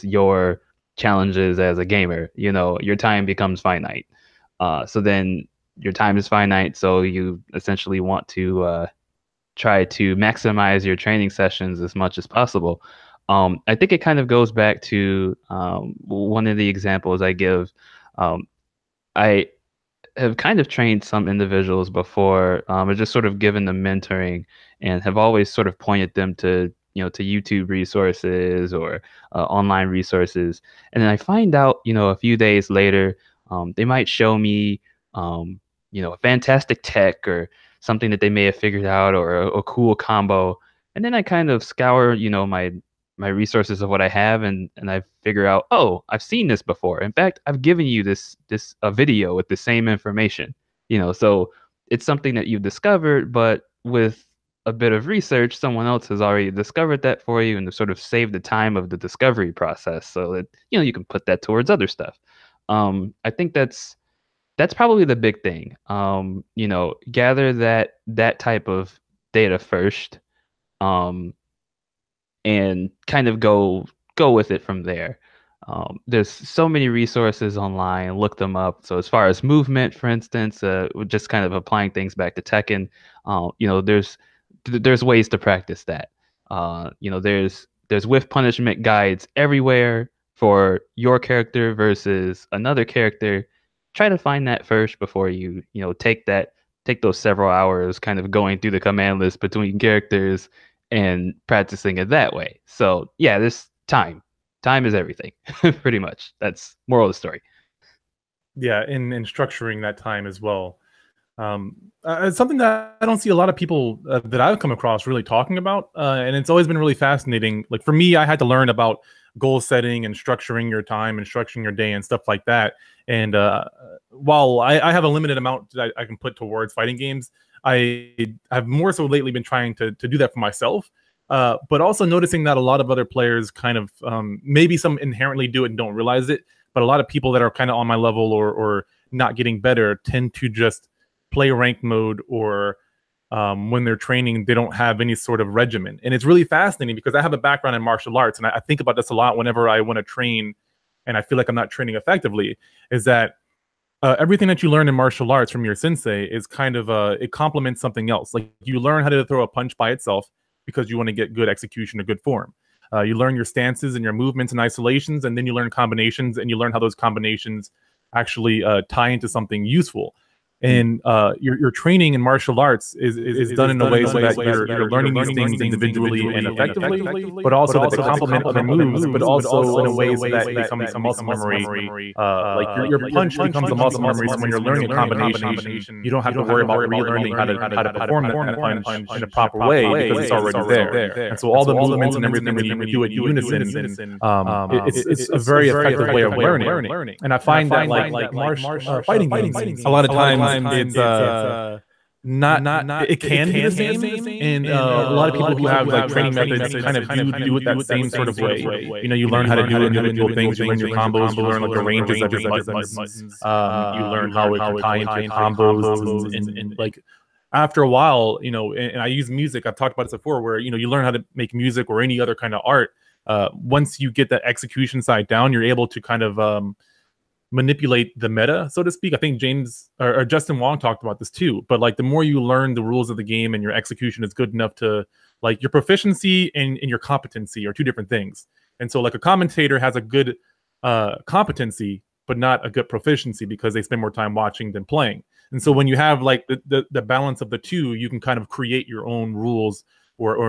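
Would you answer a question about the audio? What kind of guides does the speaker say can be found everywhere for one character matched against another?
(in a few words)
Punishment guides.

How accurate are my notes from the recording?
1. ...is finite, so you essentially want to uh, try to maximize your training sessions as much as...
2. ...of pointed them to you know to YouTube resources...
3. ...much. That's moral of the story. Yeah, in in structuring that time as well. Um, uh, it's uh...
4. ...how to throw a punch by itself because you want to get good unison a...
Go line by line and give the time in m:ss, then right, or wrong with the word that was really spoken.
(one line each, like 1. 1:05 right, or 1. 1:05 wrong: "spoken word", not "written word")
1. 0:06 right
2. 0:25 right
3. 1:45 right
4. 2:39 wrong: "execution", not "unison".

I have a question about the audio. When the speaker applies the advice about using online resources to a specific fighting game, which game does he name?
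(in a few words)
Tekken.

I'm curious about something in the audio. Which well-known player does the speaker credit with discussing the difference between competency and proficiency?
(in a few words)
Justin Wong.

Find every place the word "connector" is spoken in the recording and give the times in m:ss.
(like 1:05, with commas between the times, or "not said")
not said.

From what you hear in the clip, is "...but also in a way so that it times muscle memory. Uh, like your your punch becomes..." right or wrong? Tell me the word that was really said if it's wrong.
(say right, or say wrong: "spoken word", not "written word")
wrong: "becomes", not "times".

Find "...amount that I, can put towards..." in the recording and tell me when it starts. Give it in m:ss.
2:05.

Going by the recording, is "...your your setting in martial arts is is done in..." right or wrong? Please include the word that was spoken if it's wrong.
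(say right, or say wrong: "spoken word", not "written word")
wrong: "training", not "setting".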